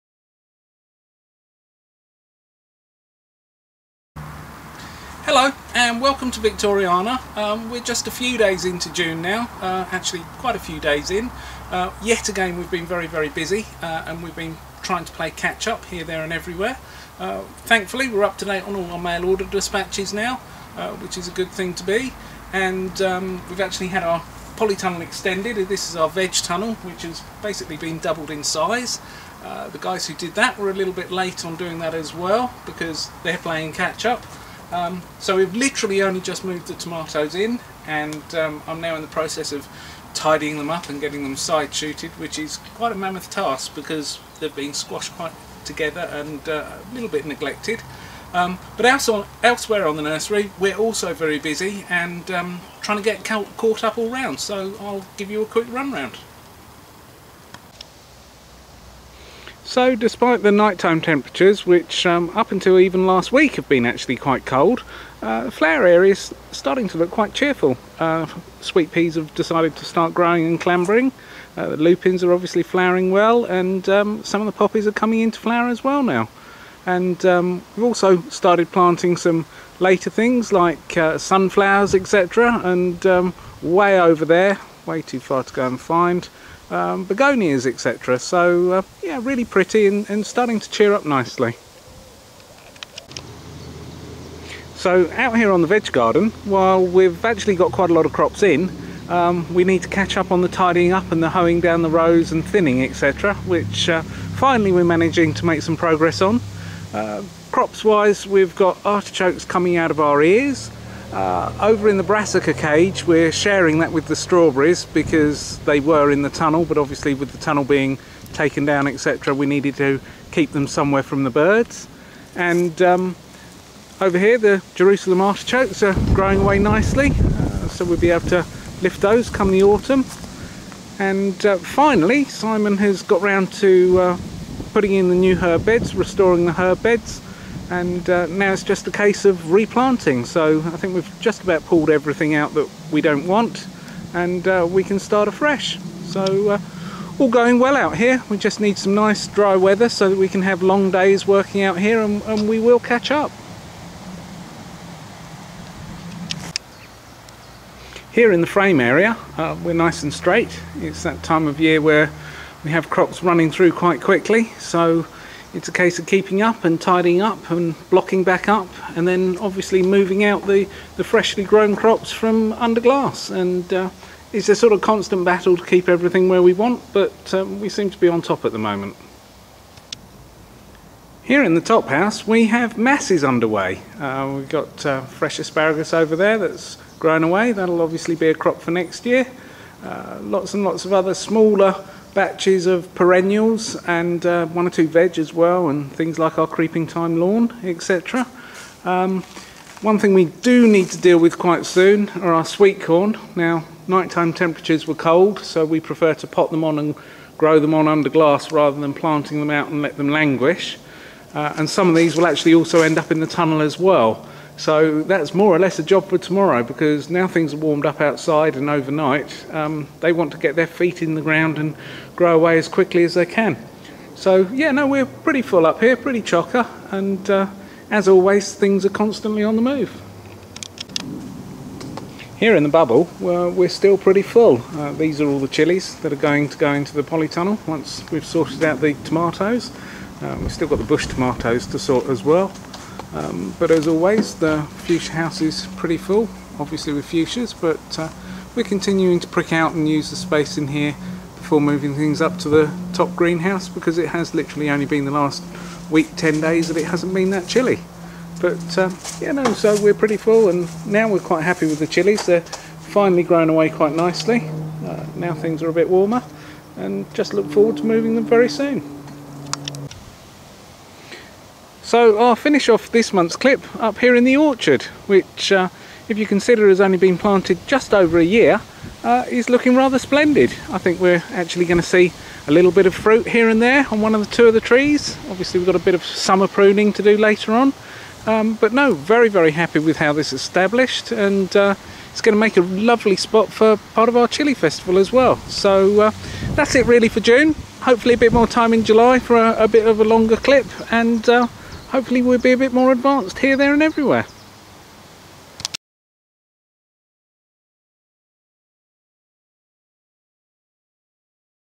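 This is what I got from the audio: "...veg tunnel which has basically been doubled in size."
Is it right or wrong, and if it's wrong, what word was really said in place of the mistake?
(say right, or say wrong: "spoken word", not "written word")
right.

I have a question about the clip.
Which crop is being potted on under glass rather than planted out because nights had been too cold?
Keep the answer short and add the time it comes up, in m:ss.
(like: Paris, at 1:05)
Sweet corn, at 3:22.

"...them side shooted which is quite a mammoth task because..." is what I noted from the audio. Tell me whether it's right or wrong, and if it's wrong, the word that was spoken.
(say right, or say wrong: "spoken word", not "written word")
right.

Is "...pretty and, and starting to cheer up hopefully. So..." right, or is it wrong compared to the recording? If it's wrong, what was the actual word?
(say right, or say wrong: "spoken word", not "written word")
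wrong: "nicely", not "hopefully".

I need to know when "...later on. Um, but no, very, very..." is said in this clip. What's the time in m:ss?
4:47.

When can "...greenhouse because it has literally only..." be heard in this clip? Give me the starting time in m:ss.
4:13.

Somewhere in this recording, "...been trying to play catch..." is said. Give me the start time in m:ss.
0:14.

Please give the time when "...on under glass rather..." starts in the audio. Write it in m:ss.
3:27.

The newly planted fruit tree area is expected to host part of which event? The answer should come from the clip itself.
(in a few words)
Chili festival.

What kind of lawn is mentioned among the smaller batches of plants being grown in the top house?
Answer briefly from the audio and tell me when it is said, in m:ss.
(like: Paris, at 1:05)
Creeping thyme lawn, at 3:16.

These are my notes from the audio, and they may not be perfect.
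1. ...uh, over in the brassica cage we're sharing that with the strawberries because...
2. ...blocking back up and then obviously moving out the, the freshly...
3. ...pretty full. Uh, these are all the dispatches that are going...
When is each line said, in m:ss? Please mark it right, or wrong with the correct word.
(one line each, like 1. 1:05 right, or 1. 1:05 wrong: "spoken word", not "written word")
1. 1:51 right
2. 2:47 right
3. 3:53 wrong: "chilies", not "dispatches".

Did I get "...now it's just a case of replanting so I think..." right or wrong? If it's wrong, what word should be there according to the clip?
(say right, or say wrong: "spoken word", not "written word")
right.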